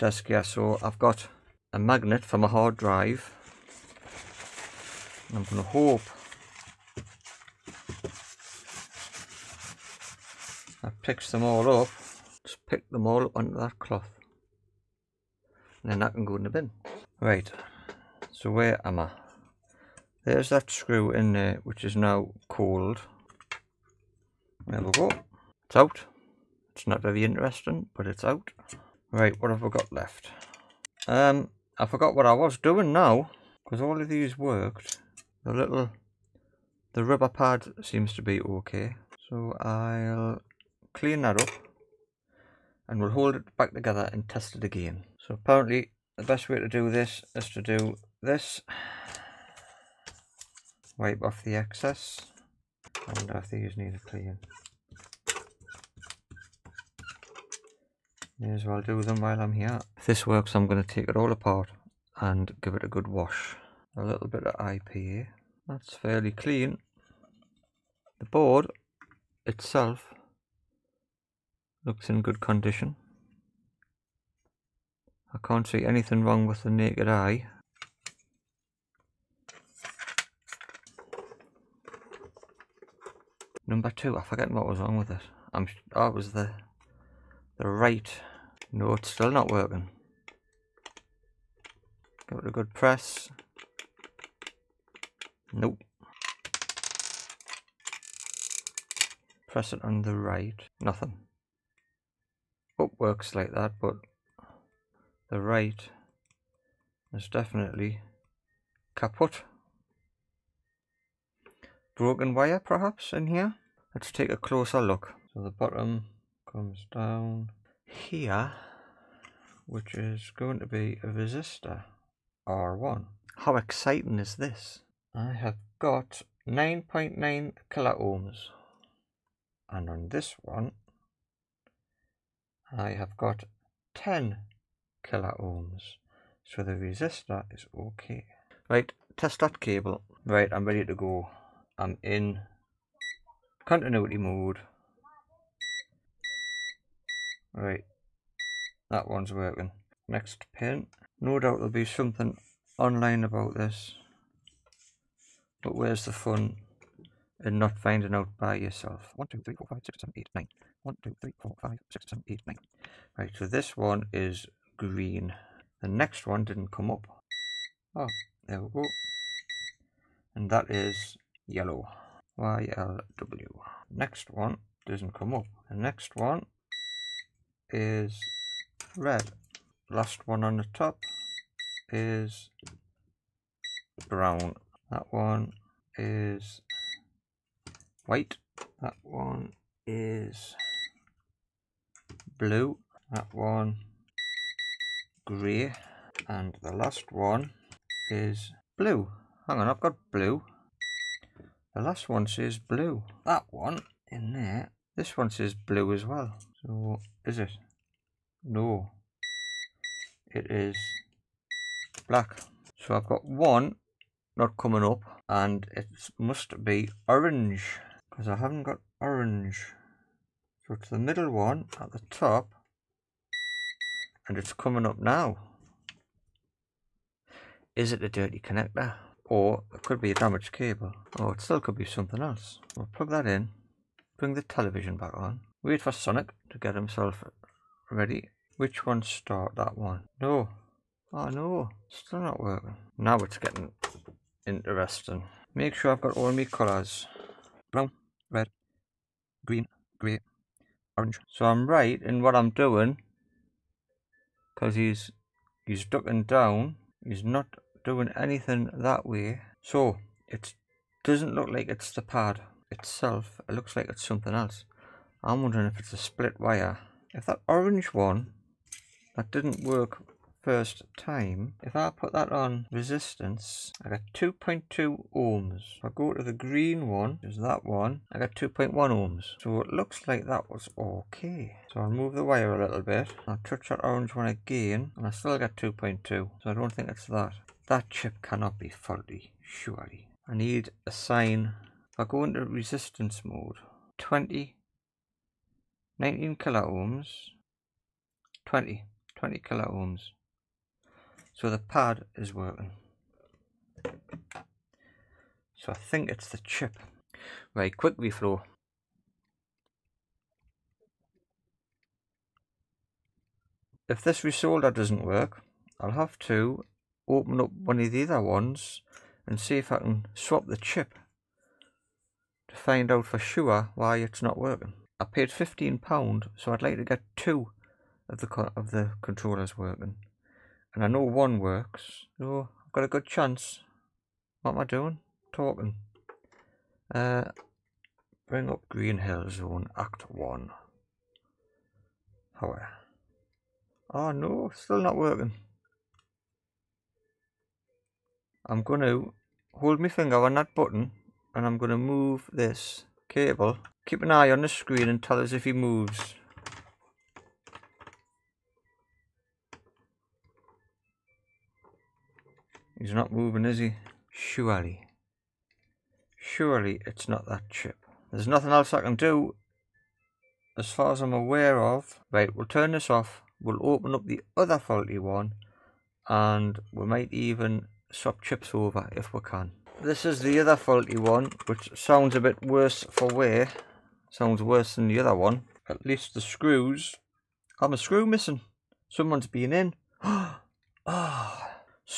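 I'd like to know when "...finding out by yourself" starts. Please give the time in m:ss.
2:37.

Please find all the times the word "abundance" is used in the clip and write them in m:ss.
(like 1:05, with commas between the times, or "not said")
not said.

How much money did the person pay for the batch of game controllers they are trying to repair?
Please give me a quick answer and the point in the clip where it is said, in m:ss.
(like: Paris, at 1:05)
£15, at 5:25.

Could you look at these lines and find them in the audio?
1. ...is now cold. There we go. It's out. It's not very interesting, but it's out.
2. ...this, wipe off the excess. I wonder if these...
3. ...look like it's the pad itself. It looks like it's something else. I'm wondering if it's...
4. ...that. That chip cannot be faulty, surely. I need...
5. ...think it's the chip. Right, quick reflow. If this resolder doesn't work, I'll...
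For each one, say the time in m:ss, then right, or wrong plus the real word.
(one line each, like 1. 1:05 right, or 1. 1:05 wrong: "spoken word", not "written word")
1. 0:21 right
2. 0:48 right
3. 4:21 right
4. 4:47 right
5. 5:05 right.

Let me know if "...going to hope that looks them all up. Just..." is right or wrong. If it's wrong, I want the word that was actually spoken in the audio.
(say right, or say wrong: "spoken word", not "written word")
wrong: "picks", not "looks".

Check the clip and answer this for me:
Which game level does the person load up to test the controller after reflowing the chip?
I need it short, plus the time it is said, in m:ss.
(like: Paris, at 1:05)
Green Hill Zone Act 1, at 5:38.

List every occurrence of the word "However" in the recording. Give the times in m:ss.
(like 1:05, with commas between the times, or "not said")
5:42.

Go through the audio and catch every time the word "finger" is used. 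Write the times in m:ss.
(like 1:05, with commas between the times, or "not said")
5:49.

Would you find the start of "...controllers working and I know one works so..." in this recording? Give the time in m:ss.
5:29.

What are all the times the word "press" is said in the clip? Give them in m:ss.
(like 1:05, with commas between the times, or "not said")
1:32, 1:39.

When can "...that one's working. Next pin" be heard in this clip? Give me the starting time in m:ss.
2:28.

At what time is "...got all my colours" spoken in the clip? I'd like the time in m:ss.
4:06.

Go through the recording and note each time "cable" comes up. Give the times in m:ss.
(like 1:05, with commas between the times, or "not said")
2:19, 3:50, 5:53.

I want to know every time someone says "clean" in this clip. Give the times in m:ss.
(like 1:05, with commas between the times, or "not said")
0:40, 0:54, 1:06.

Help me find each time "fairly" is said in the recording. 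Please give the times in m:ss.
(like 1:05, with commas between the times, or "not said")
1:05.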